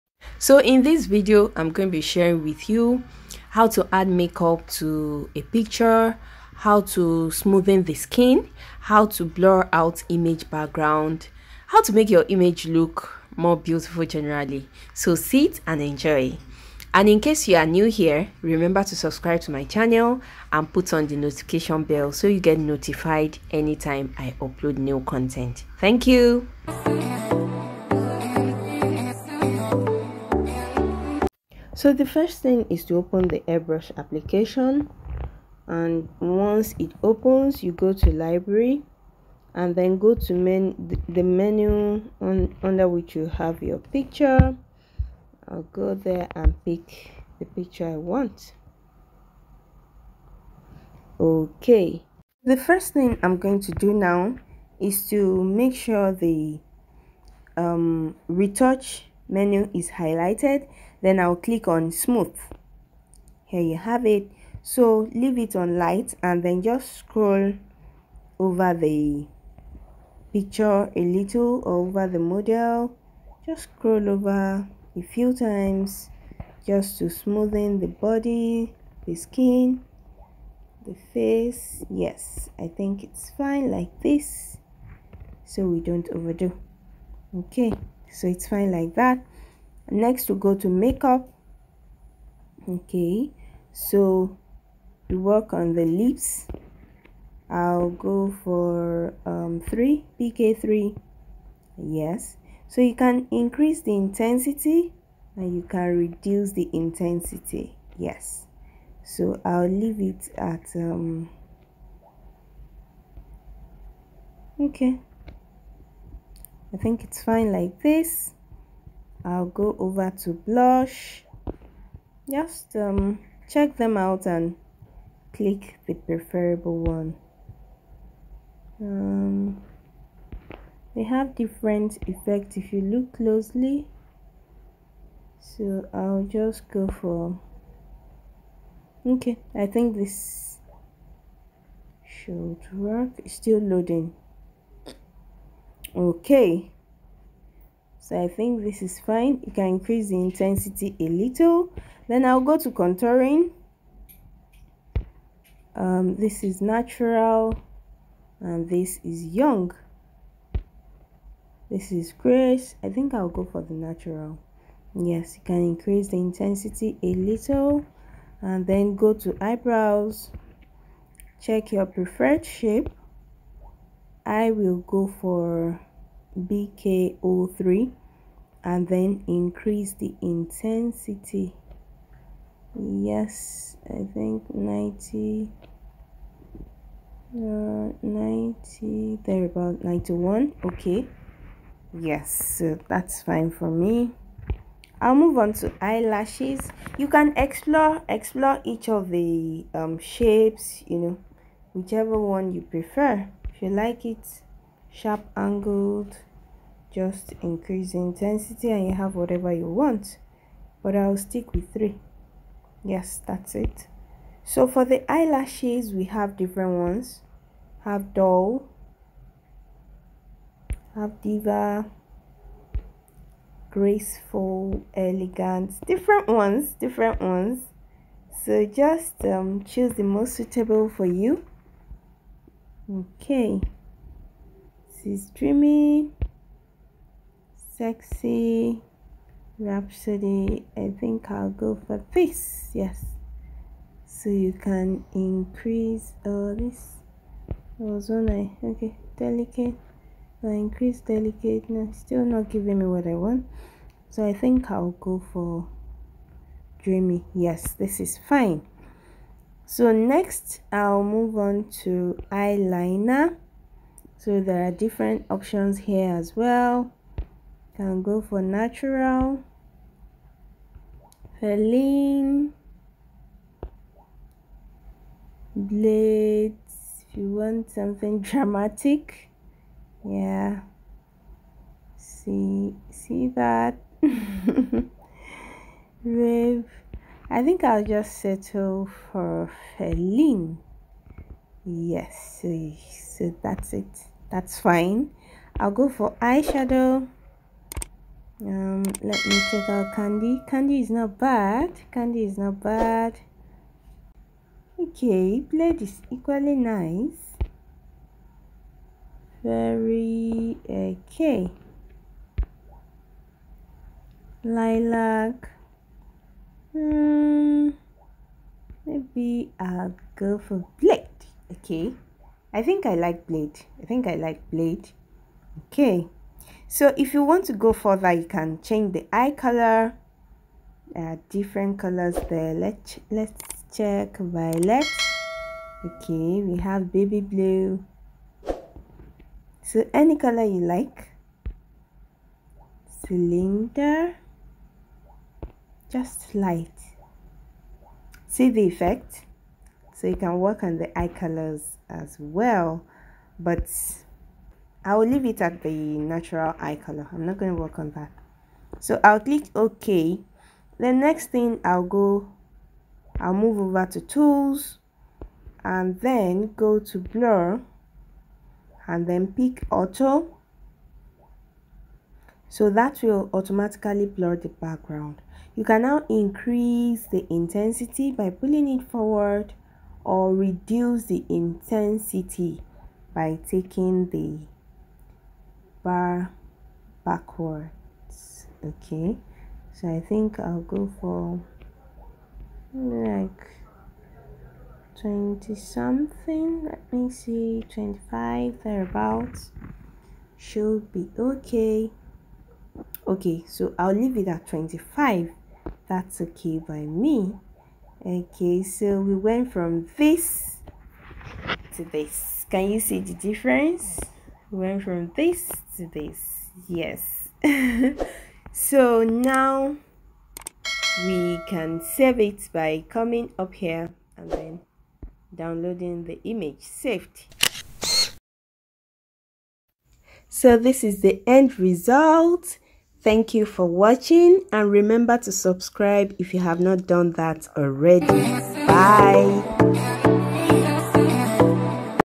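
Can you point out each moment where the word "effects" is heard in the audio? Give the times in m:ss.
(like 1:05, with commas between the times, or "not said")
2:12, 5:48.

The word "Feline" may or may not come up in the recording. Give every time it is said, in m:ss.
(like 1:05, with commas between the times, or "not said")
4:31, 4:49.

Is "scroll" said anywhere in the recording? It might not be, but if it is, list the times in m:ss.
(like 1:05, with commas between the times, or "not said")
1:06, 1:13.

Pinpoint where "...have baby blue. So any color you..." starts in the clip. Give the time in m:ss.
5:36.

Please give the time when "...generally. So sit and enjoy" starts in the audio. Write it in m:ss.
0:14.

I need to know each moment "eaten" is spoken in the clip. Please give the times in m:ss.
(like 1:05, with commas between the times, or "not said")
not said.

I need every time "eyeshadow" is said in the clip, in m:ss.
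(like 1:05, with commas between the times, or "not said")
4:56.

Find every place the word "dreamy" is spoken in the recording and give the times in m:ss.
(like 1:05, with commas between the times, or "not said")
3:55, 4:16.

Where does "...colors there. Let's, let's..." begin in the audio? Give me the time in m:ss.
5:31.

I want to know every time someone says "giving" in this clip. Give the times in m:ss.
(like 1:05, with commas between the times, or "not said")
4:12.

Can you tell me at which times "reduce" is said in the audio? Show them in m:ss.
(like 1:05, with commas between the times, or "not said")
1:45, 6:20.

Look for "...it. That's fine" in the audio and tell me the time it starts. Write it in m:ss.
4:53.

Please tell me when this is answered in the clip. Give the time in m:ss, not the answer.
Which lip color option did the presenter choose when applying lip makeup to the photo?
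1:40.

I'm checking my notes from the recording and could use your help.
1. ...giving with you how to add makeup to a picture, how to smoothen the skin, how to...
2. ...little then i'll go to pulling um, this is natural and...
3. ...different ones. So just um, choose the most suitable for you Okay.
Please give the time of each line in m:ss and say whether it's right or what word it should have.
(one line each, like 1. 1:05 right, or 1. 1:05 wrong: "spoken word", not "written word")
1. 0:02 wrong: "sharing", not "giving"
2. 2:31 wrong: "contouring", not "pulling"
3. 3:46 right.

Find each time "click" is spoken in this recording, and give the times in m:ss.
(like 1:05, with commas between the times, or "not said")
1:01, 2:05, 5:59.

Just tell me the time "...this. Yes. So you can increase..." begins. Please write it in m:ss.
4:02.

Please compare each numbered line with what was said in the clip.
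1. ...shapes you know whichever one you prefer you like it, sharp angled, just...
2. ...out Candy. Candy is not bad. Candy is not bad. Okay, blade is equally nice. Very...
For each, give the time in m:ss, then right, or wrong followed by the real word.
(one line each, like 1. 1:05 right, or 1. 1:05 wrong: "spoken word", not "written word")
1. 3:19 right
2. 4:59 right.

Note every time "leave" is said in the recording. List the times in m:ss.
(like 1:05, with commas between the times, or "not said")
1:05, 1:49, 5:55, 6:43.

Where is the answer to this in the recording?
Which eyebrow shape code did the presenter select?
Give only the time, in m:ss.
2:56.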